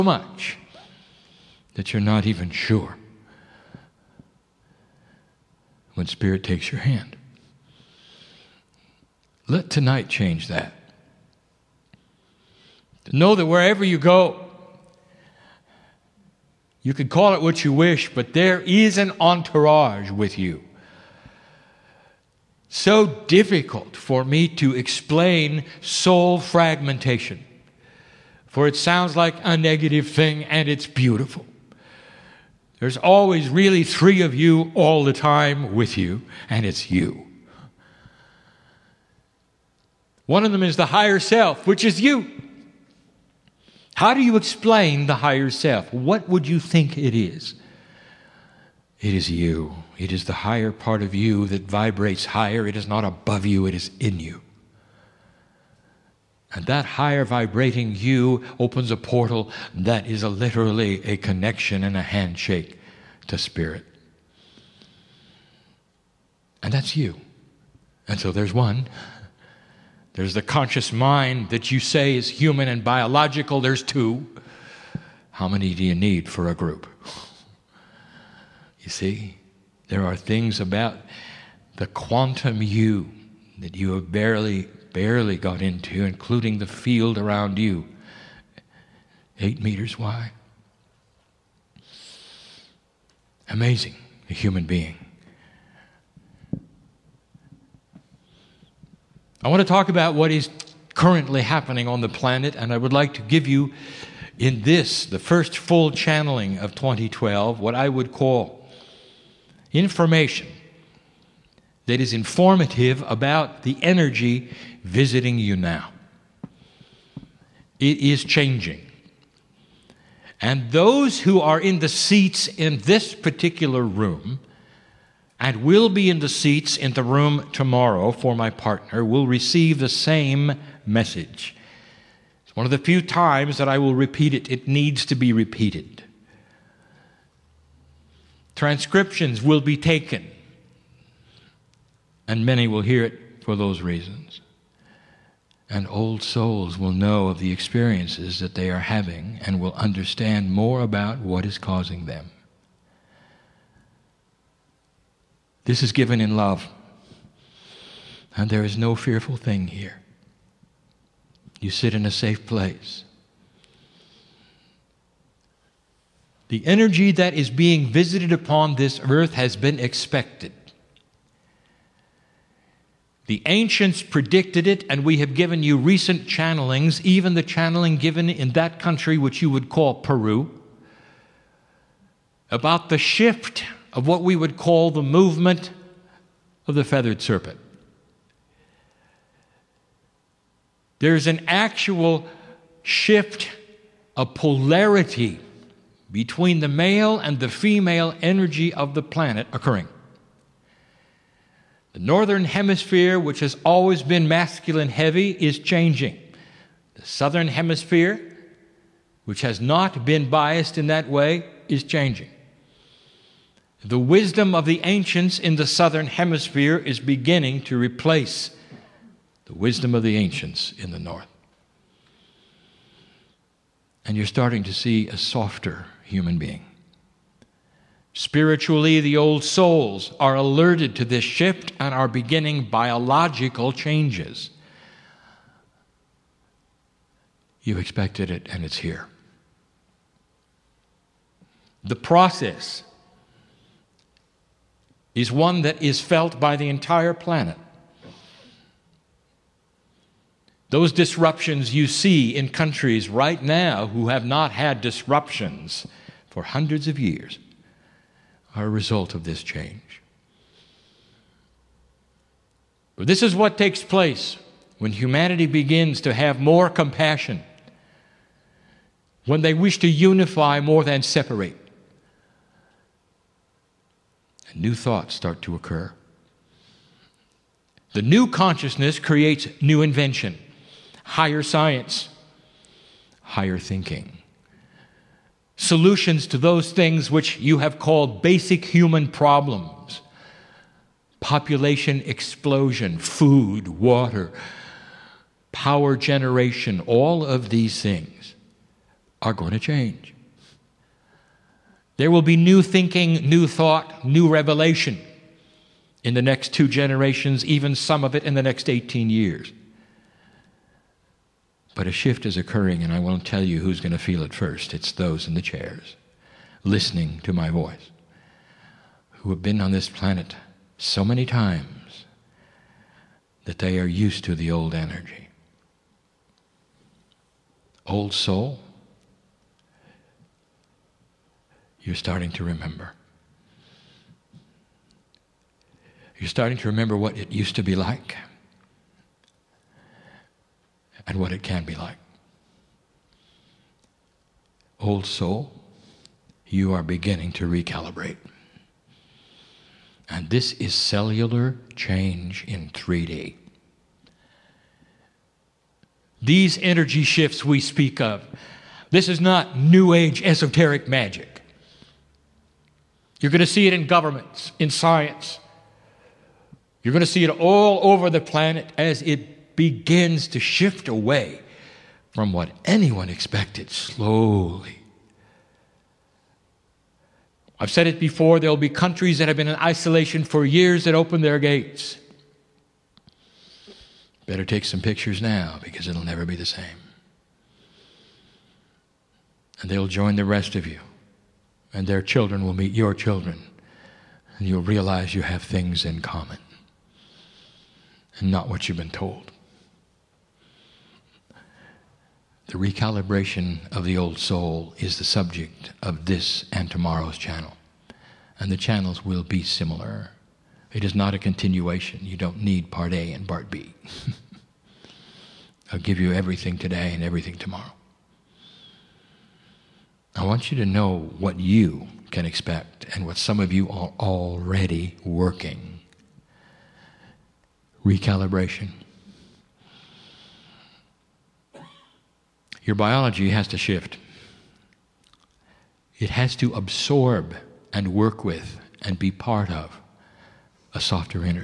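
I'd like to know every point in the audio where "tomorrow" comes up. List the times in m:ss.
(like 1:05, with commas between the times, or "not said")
2:07, 6:46, 6:57.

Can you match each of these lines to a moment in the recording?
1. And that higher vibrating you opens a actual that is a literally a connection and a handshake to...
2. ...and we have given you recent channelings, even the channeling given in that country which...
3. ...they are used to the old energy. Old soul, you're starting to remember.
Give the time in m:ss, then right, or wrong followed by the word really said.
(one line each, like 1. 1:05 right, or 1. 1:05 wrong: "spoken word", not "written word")
1. 0:56 wrong: "portal", not "actual"
2. 2:54 right
3. 5:23 right.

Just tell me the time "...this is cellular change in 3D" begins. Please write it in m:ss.
5:50.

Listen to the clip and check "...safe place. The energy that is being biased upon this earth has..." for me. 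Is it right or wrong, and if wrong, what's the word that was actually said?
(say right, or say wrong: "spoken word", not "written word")
wrong: "visited", not "biased".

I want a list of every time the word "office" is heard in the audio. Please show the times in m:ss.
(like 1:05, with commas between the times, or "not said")
not said.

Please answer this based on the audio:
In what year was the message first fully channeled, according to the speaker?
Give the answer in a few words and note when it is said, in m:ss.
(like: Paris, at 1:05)
2012, at 1:46.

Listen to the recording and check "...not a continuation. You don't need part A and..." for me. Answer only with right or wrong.
right.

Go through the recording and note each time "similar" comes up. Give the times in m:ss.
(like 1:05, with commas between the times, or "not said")
6:49.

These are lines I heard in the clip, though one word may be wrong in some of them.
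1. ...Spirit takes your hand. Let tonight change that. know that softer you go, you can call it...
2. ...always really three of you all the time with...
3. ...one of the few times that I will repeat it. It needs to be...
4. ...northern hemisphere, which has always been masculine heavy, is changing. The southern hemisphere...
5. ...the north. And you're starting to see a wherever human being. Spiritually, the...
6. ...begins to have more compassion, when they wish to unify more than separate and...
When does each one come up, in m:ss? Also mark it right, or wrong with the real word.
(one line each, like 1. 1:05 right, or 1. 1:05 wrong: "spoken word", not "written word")
1. 0:06 wrong: "wherever", not "softer"
2. 0:32 right
3. 2:12 right
4. 3:21 right
5. 3:40 wrong: "softer", not "wherever"
6. 4:25 right.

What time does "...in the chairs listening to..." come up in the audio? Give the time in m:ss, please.
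5:15.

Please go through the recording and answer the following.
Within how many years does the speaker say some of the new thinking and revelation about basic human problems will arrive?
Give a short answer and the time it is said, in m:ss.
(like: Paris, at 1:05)
18, at 5:08.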